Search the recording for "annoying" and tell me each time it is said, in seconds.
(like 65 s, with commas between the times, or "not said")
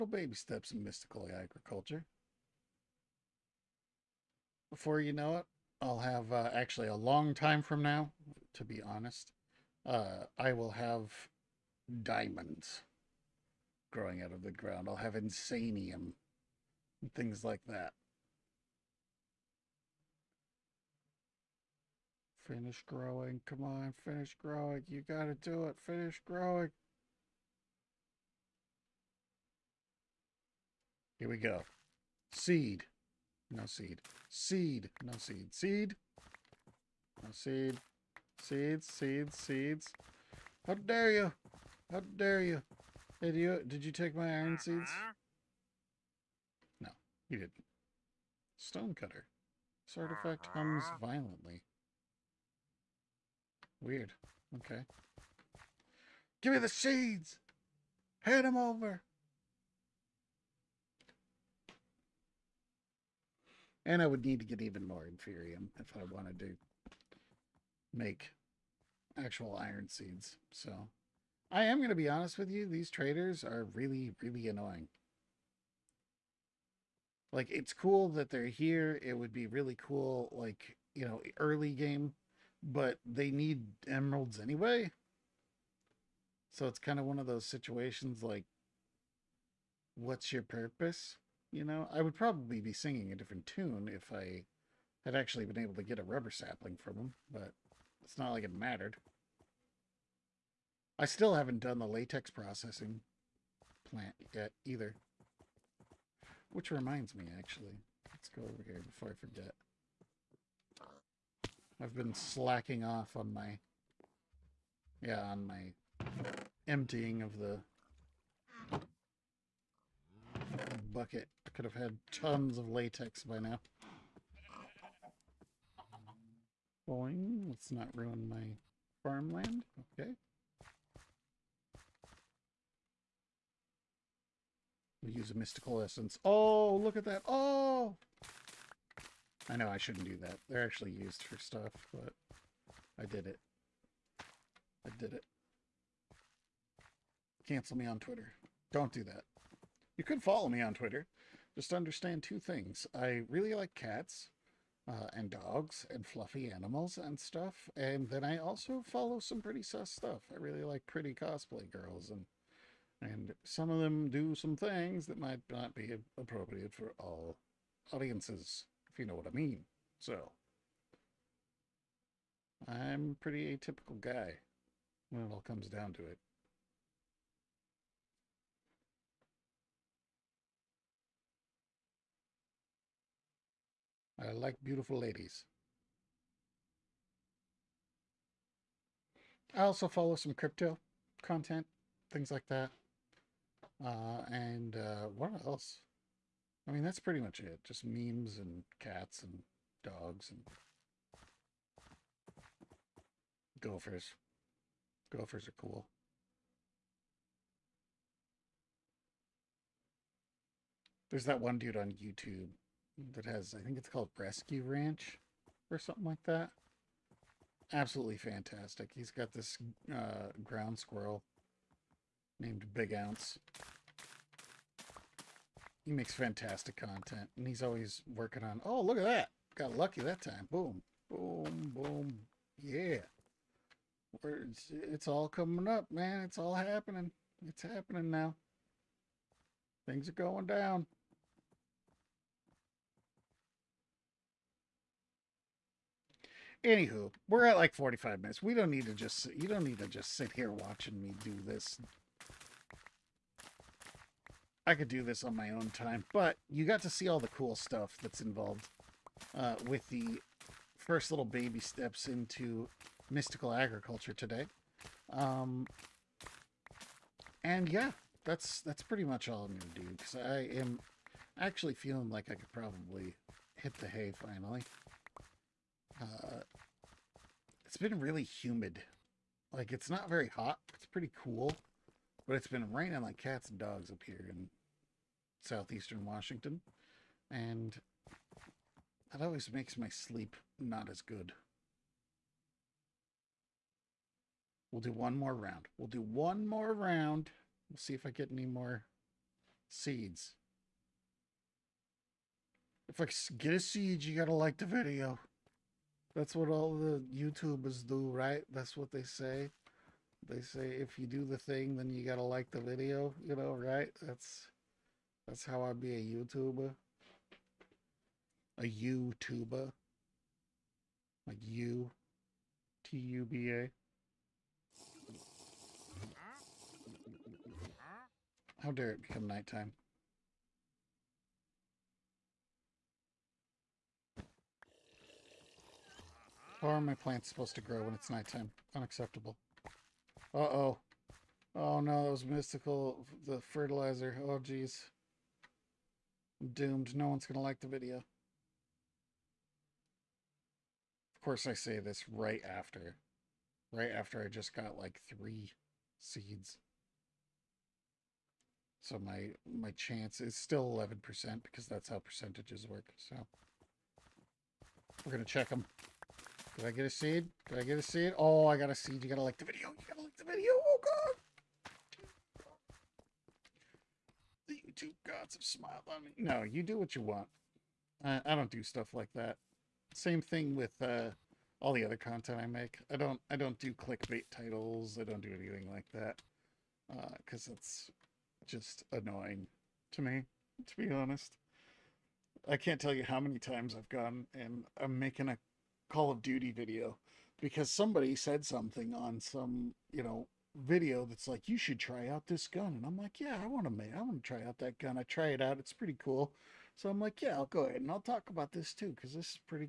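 74 s, 388 s.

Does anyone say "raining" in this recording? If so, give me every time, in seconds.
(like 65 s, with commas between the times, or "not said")
282 s.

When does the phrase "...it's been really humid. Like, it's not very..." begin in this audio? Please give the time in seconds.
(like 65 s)
277 s.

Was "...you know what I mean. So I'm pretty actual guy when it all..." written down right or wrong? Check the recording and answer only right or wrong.
wrong.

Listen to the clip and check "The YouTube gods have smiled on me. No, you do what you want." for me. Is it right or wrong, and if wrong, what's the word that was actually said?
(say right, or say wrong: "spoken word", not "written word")
right.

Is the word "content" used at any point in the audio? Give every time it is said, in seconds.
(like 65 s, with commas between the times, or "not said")
191 s, 226 s, 381 s.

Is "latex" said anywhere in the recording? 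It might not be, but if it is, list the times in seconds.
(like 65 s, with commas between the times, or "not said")
101 s, 122 s.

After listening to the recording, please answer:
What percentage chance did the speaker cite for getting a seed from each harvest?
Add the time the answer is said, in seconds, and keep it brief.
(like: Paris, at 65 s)
11%, at 360 s.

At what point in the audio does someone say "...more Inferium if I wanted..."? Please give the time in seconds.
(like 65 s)
64 s.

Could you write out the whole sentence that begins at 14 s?
I'll have insanium and things like that.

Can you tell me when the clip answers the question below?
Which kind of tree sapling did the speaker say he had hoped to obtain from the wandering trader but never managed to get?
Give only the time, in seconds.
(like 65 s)
96 s.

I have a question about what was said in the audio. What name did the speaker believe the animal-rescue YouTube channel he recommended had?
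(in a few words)
Rescue Ranch.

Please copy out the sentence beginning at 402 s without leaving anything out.
And I'm like, yeah, I want to, man, I want to try out that gun.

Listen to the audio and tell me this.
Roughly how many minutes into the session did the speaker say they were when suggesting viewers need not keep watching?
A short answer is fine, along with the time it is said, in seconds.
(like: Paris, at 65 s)
45 minutes, at 247 s.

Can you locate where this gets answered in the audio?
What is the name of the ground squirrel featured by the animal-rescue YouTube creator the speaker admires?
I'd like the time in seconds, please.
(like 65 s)
222 s.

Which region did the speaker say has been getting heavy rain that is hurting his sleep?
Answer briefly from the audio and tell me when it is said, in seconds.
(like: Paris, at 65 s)
southeastern Washington, at 285 s.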